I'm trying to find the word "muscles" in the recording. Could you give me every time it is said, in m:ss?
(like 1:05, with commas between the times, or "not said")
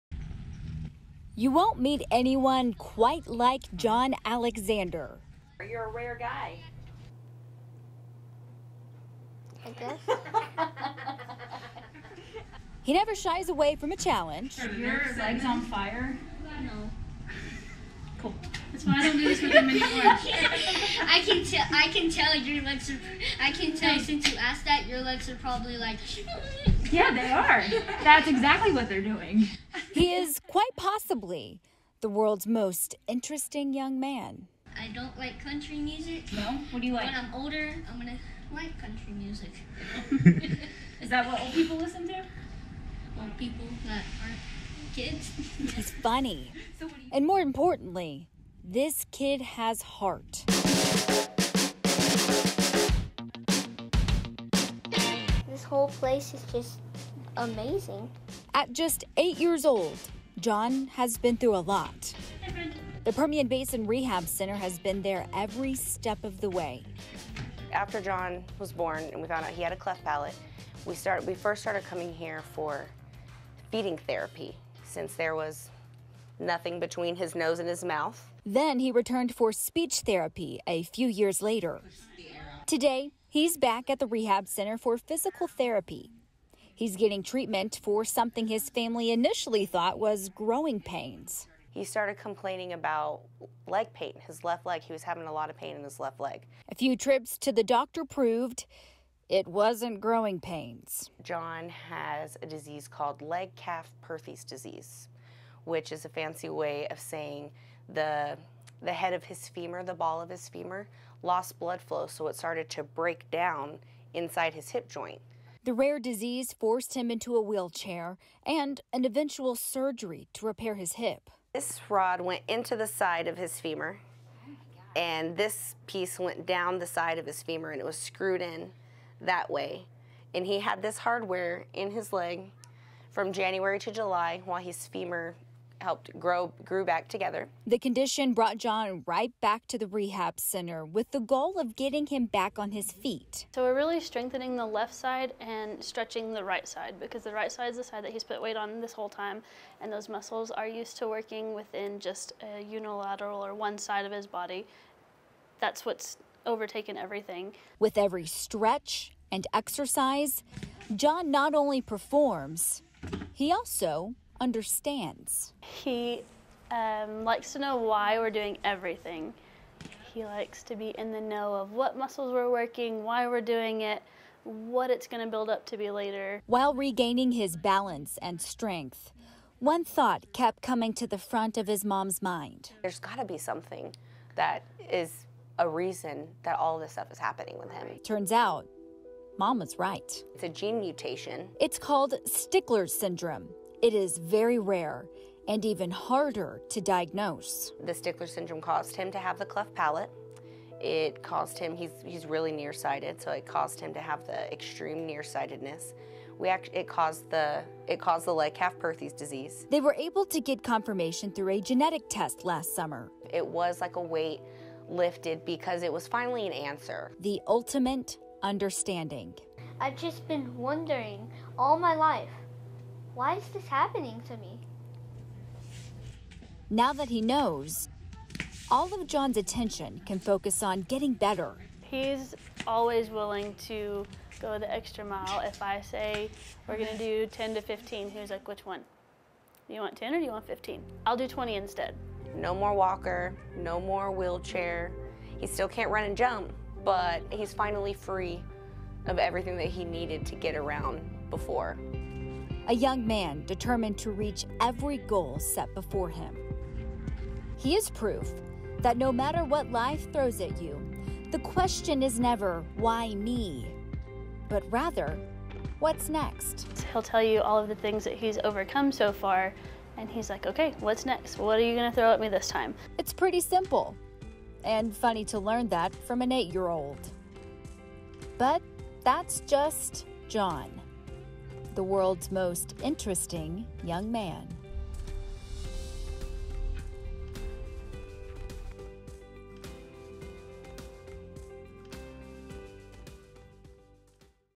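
2:30, 2:51.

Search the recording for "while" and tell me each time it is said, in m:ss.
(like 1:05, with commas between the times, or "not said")
2:14, 2:56.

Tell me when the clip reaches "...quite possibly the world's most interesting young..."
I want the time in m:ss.
0:30.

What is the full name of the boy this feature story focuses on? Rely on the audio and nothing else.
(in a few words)
John Alexander.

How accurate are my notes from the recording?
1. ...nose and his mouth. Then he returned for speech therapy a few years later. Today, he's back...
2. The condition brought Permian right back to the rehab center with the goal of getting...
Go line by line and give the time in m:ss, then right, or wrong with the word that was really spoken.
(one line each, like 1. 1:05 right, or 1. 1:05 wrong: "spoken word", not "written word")
1. 1:17 right
2. 2:17 wrong: "John", not "Permian".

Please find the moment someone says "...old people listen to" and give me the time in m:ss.
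0:41.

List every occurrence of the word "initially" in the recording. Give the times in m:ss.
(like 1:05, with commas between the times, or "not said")
1:29.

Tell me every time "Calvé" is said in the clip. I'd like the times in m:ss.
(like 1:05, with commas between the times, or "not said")
3:28.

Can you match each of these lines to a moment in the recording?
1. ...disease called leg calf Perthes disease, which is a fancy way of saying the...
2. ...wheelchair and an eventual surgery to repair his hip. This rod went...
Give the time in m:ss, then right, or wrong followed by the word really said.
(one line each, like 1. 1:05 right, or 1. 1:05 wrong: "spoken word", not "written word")
1. 1:42 right
2. 1:57 right.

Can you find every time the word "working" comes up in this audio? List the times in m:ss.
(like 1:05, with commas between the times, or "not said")
2:31, 2:52.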